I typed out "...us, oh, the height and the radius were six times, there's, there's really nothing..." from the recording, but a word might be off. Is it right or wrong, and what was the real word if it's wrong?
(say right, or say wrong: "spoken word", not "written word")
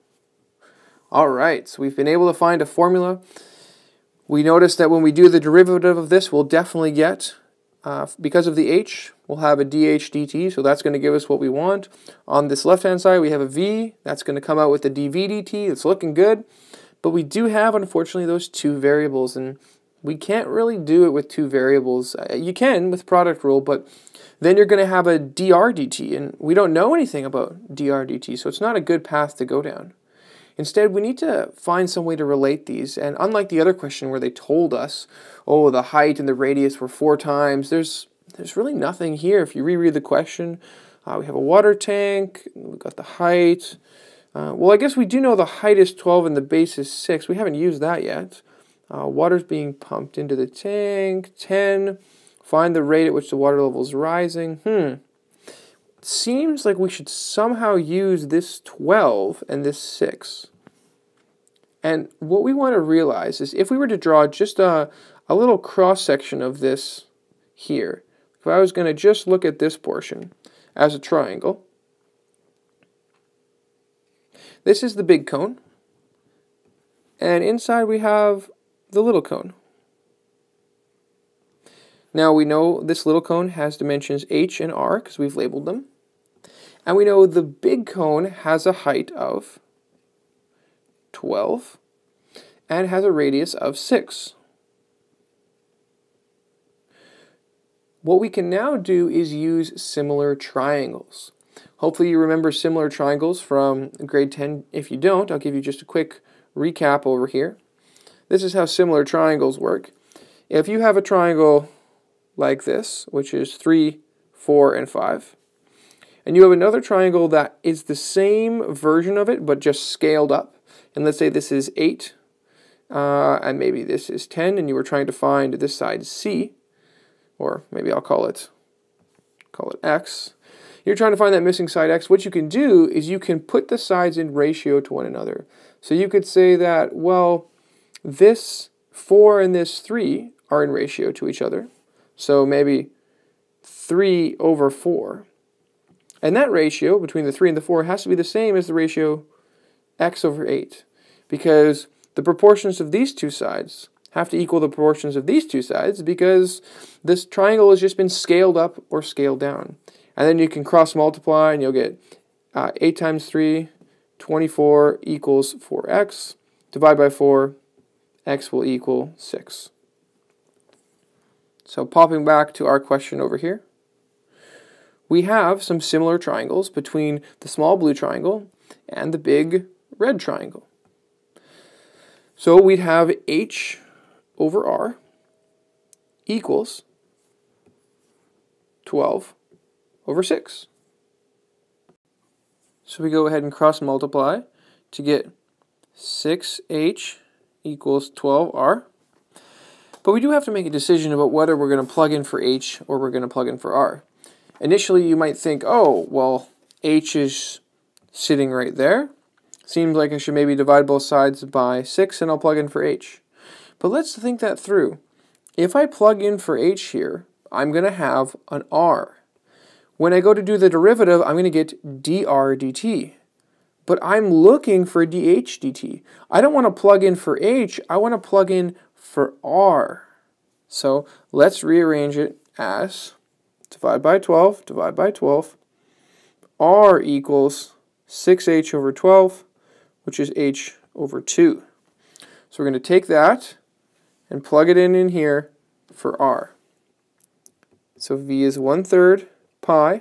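wrong: "four", not "six".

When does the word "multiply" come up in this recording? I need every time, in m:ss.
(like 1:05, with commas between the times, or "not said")
2:40, 3:13.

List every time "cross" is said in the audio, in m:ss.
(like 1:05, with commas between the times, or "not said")
1:05, 2:40, 3:13.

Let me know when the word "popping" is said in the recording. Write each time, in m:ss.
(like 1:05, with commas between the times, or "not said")
2:51.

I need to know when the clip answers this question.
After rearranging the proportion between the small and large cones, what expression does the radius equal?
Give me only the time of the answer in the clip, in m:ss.
4:00.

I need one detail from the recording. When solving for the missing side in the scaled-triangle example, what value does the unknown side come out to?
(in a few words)
6.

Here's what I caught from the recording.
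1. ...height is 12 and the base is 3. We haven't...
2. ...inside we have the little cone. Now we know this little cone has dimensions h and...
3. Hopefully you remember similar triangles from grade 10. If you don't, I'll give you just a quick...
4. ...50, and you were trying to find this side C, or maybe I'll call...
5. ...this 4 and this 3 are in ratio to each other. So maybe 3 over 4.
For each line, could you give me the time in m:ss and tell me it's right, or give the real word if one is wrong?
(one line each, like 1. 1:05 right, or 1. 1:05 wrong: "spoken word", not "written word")
1. 0:45 wrong: "6", not "3"
2. 1:17 right
3. 1:41 right
4. 2:04 wrong: "10", not "50"
5. 2:18 right.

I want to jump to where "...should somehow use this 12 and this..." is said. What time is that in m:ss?
0:56.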